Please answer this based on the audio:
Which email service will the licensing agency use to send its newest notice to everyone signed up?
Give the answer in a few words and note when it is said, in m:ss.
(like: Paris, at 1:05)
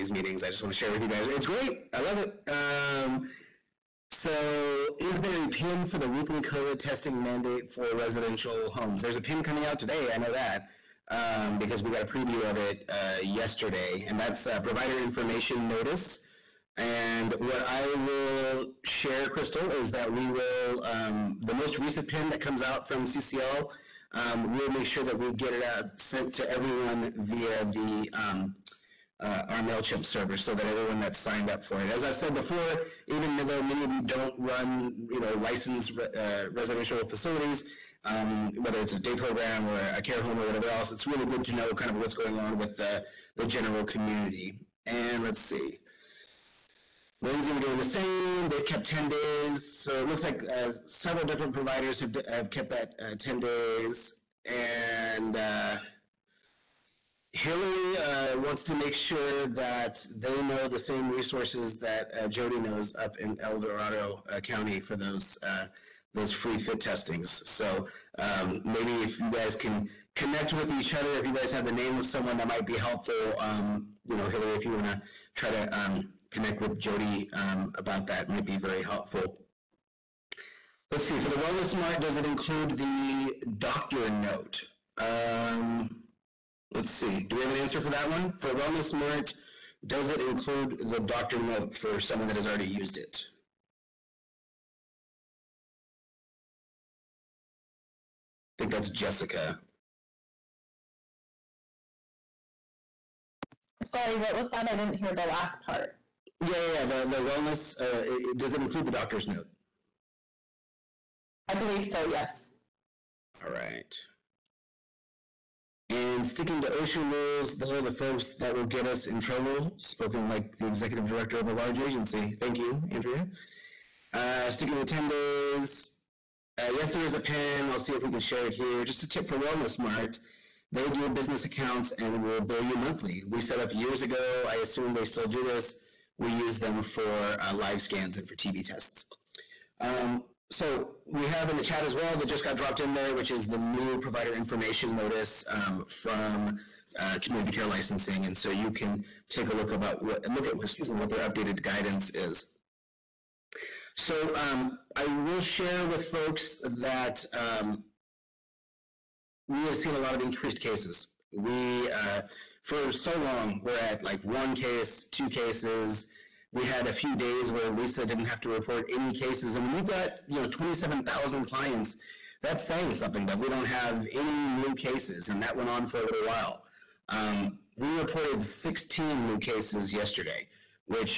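MailChimp, at 0:29.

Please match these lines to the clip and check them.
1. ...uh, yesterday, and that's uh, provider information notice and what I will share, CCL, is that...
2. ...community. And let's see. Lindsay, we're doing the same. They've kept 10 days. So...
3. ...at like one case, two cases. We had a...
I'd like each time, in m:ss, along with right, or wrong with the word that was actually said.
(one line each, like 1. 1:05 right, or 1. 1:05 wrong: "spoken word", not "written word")
1. 0:12 wrong: "Crystal", not "CCL"
2. 0:43 right
3. 2:43 right.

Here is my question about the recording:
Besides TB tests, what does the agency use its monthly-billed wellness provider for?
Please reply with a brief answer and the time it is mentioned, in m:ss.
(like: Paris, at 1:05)
Live scans, at 2:17.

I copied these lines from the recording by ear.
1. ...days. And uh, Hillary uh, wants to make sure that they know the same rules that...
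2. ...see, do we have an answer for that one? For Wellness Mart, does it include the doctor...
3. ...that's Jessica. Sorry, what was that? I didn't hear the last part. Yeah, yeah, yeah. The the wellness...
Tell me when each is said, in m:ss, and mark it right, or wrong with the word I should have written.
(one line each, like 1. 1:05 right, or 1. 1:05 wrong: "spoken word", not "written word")
1. 0:53 wrong: "resources", not "rules"
2. 1:26 right
3. 1:38 right.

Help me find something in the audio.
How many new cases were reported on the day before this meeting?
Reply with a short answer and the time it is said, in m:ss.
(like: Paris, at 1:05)
16, at 2:58.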